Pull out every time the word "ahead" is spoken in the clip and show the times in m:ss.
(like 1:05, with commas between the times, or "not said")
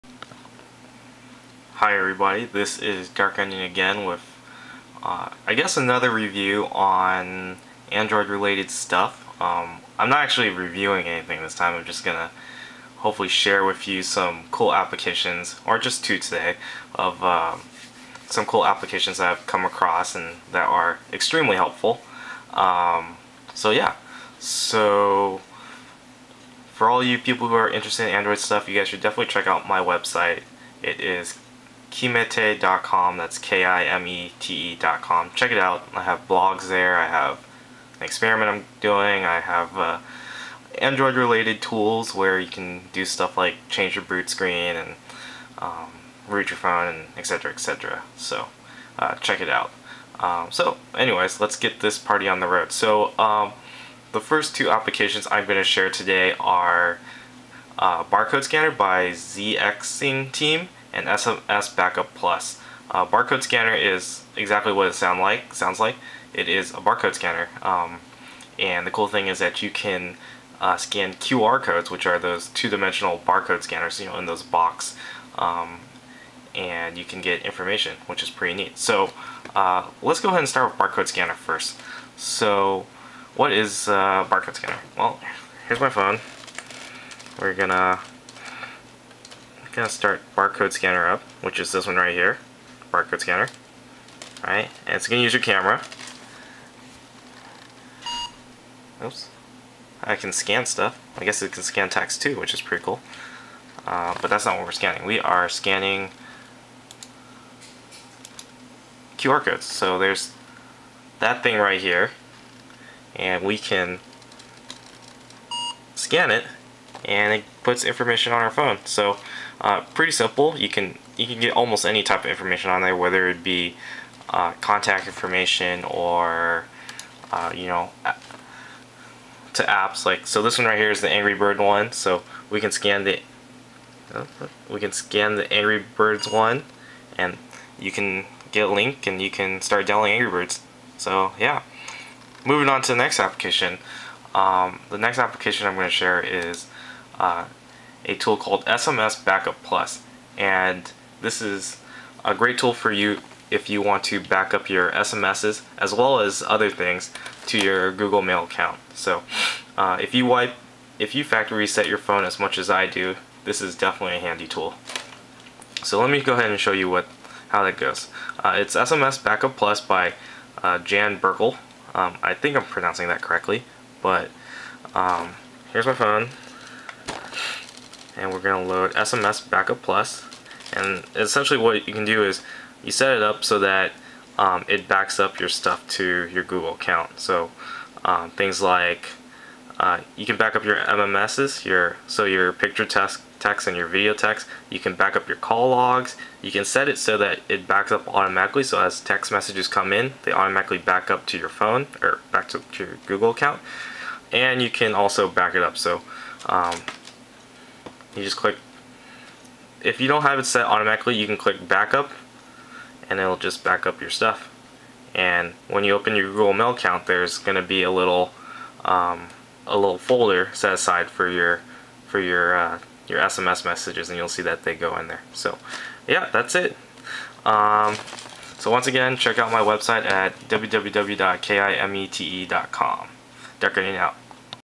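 1:20, 2:46.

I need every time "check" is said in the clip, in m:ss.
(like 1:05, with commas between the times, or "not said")
0:29, 0:35, 0:49, 3:49.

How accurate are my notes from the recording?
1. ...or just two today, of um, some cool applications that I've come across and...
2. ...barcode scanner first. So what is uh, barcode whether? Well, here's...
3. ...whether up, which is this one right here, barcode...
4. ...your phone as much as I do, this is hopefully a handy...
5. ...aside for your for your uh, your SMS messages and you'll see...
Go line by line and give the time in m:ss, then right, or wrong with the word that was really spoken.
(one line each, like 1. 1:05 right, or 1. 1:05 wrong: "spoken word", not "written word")
1. 0:15 right
2. 1:20 wrong: "scanner", not "whether"
3. 1:30 wrong: "scanner", not "whether"
4. 2:41 wrong: "definitely", not "hopefully"
5. 3:40 right.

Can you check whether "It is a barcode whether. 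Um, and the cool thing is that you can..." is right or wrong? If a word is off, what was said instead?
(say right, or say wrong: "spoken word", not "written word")
wrong: "scanner", not "whether".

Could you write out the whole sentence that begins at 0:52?
So um, the first two applications I'm going to share today are uh, Barcode Scanner by ZXing Team and SMS Backup Plus.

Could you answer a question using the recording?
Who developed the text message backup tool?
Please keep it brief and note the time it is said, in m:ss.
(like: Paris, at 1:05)
Jan Berkel, at 2:50.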